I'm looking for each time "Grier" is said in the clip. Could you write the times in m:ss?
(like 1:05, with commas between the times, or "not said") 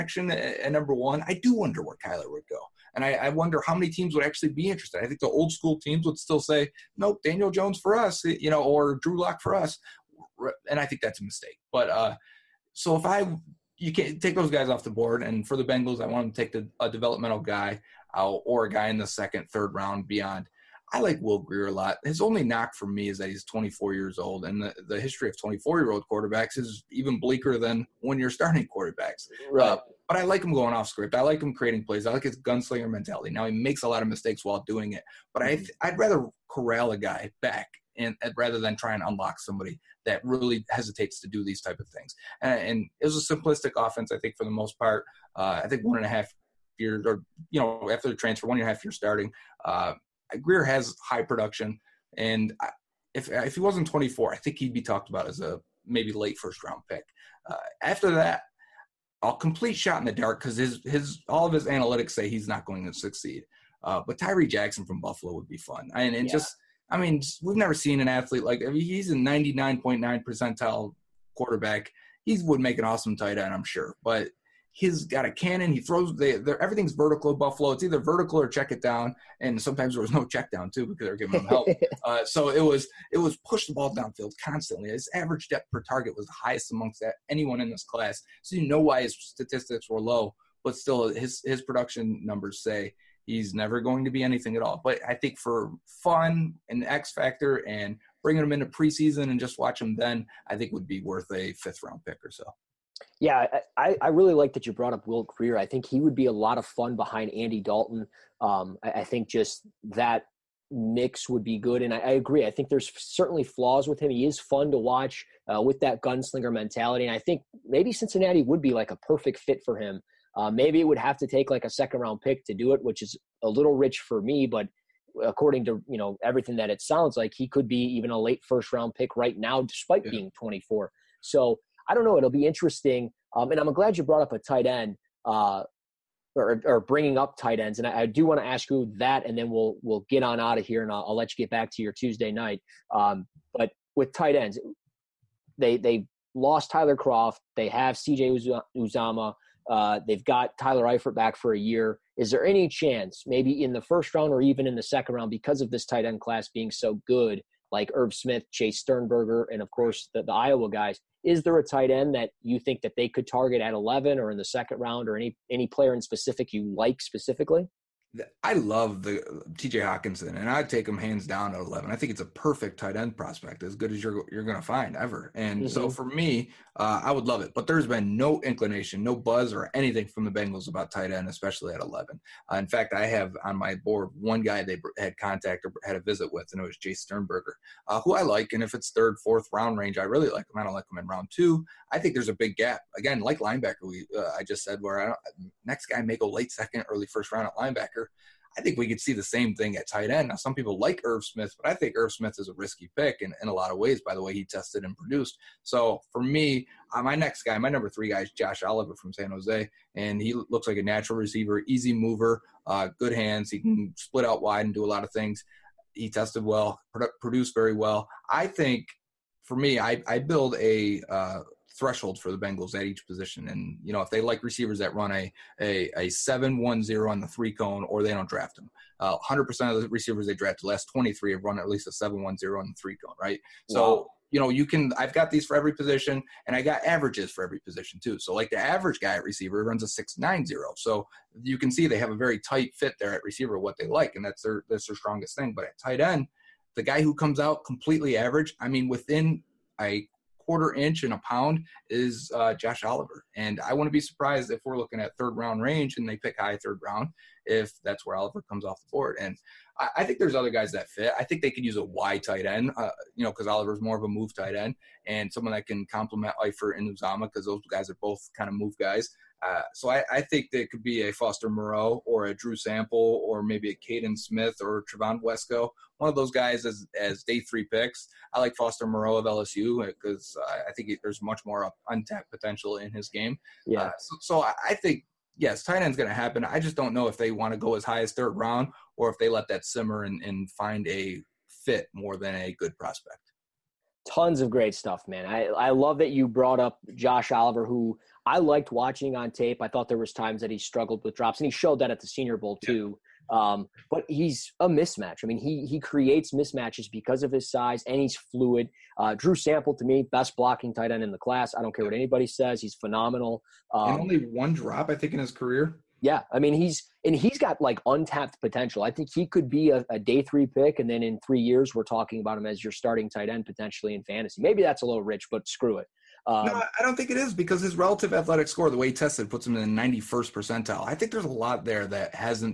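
0:21, 0:50, 1:45.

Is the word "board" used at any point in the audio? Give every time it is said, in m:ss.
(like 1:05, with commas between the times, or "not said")
0:14, 3:03, 4:18.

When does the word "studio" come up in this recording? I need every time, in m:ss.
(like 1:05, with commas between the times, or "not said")
not said.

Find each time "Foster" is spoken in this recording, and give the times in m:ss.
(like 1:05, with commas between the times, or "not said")
4:31, 4:38.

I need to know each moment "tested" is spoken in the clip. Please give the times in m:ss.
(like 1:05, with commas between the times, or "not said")
3:24, 3:36, 5:28.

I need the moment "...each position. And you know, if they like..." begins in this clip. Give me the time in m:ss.
3:42.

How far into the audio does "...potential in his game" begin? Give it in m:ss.
4:42.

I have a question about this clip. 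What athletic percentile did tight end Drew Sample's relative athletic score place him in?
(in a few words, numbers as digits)
91st percentile.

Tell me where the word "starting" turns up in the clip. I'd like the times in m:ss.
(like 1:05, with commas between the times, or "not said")
0:28, 0:48, 5:22.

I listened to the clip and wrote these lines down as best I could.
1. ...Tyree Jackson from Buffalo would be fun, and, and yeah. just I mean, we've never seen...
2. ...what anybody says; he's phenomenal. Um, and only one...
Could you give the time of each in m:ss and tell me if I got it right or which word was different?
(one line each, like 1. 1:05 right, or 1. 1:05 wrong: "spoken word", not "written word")
1. 1:04 right
2. 5:11 right.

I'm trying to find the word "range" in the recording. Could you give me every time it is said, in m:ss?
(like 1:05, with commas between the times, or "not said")
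3:09, 4:15.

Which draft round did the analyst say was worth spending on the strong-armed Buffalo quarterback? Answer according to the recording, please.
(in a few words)
fifth round.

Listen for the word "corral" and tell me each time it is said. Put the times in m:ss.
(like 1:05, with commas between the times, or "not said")
0:36.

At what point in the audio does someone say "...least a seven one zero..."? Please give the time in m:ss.
3:51.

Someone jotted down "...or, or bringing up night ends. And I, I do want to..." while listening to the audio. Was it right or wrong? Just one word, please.
wrong.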